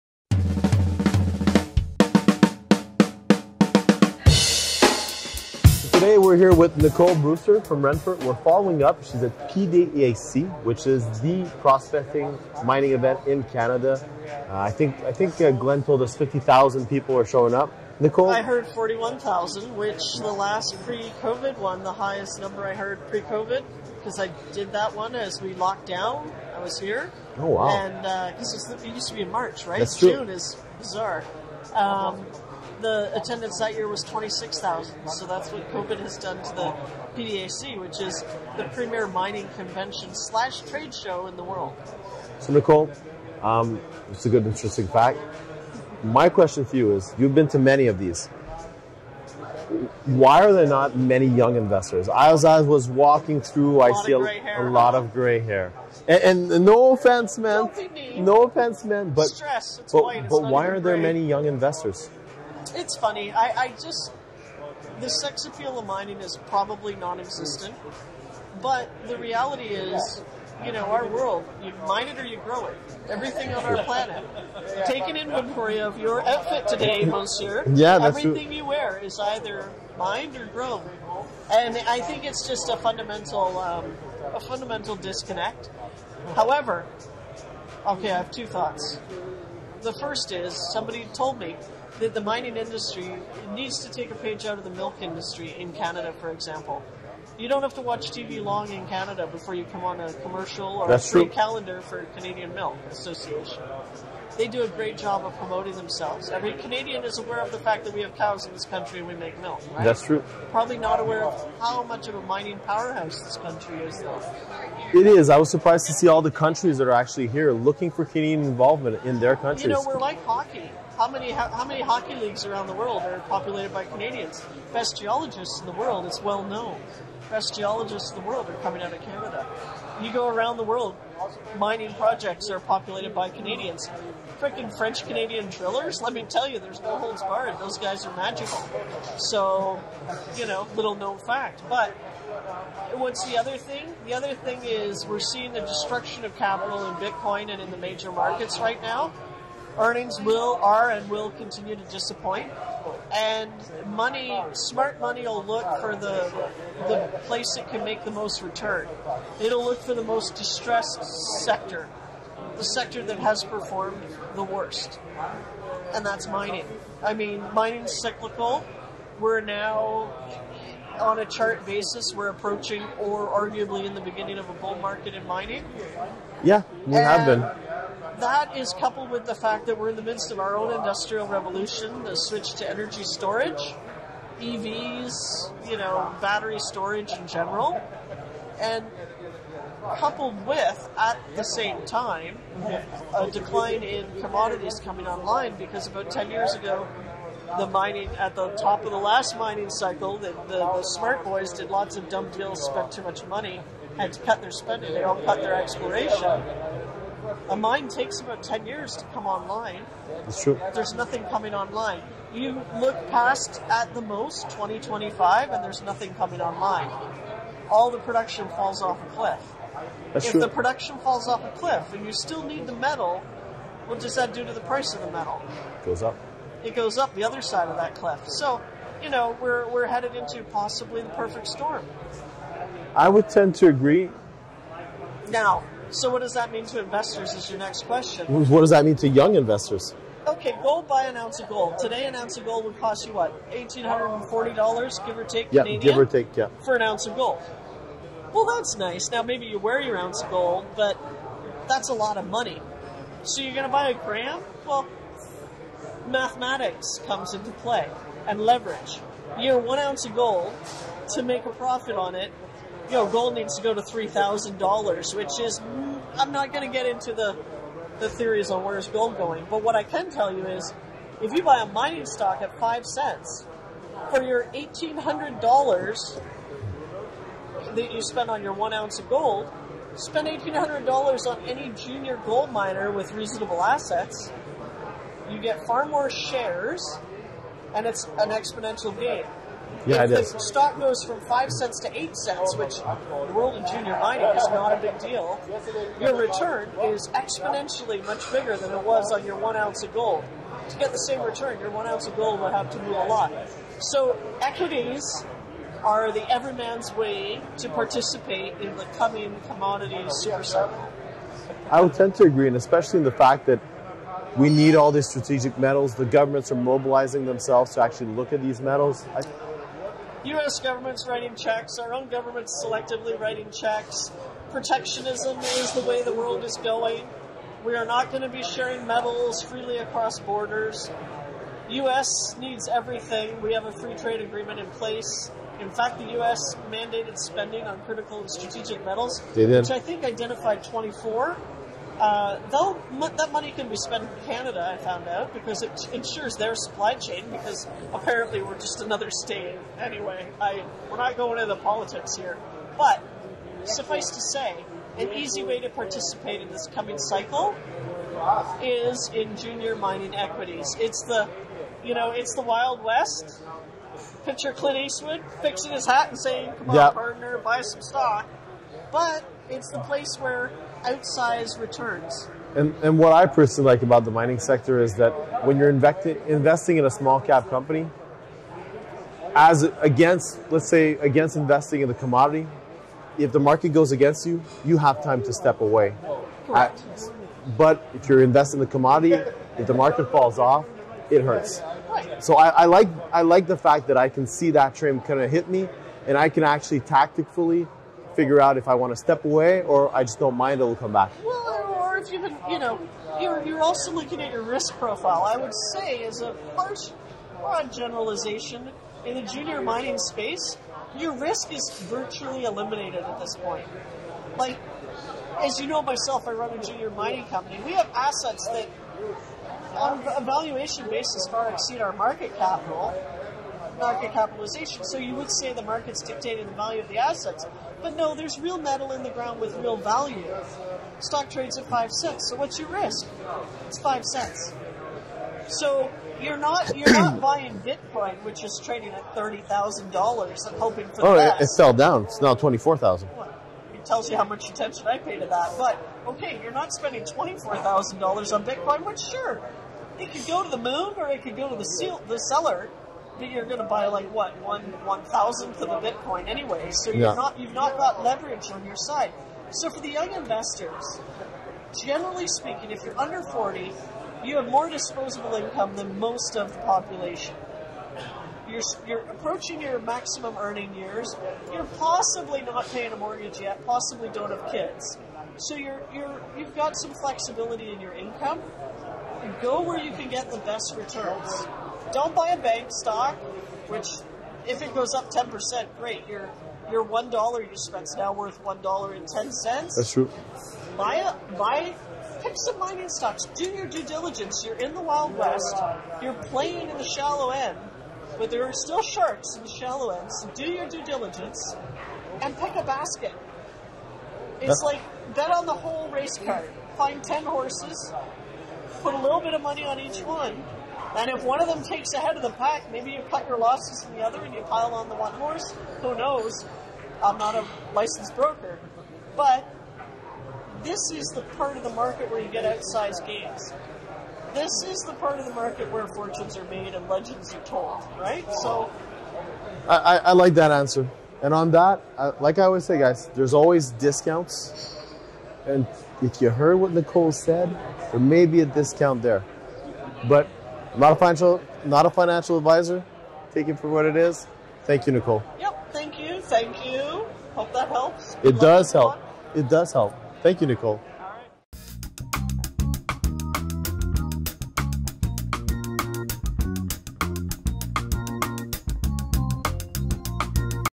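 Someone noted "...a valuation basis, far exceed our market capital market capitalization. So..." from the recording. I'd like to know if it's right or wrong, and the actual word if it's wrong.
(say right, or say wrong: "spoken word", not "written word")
right.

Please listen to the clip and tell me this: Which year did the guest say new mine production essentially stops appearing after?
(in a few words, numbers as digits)
2025.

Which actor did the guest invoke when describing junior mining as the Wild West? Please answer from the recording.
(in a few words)
Clint Eastwood.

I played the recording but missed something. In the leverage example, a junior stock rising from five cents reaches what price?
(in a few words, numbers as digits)
8 cents.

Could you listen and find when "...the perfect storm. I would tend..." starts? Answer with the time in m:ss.
3:51.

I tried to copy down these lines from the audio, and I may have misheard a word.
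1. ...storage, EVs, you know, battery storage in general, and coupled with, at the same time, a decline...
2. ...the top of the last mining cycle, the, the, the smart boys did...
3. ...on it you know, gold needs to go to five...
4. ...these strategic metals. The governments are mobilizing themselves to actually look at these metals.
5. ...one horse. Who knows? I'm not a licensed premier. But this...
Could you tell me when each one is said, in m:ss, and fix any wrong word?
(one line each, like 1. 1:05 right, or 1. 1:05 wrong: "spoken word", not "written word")
1. 3:03 right
2. 3:18 right
3. 4:21 wrong: "three", not "five"
4. 5:14 right
5. 8:34 wrong: "broker", not "premier".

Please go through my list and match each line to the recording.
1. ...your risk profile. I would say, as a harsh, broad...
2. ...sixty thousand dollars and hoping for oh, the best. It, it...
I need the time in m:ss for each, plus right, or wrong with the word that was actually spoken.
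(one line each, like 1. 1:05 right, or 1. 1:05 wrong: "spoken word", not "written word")
1. 6:44 right
2. 7:19 wrong: "thirty", not "sixty".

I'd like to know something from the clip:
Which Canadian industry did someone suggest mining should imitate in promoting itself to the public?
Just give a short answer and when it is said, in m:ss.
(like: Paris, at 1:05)
milk industry, at 1:34.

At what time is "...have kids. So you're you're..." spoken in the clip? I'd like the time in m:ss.
7:54.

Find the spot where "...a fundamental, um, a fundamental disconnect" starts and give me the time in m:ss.
1:22.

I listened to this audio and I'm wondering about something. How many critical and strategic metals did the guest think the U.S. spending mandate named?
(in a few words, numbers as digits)
24.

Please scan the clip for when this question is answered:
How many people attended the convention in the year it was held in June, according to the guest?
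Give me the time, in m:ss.
0:34.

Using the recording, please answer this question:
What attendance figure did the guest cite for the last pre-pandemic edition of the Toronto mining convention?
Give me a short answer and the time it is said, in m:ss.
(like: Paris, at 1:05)
41,000, at 0:18.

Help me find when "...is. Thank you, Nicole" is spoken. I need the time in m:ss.
9:03.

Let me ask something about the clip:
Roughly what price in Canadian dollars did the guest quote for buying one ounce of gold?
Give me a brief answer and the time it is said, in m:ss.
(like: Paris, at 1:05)
$1,840, at 4:03.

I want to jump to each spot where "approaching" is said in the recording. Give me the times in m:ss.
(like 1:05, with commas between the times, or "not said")
2:52, 7:49.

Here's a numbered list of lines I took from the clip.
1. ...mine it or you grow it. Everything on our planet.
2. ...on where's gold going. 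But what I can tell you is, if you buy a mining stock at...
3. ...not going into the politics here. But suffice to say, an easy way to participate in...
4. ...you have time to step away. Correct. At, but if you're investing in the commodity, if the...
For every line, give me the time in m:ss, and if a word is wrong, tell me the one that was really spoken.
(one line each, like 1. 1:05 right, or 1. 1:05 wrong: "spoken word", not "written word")
1. 1:11 right
2. 4:28 right
3. 5:50 right
4. 6:24 right.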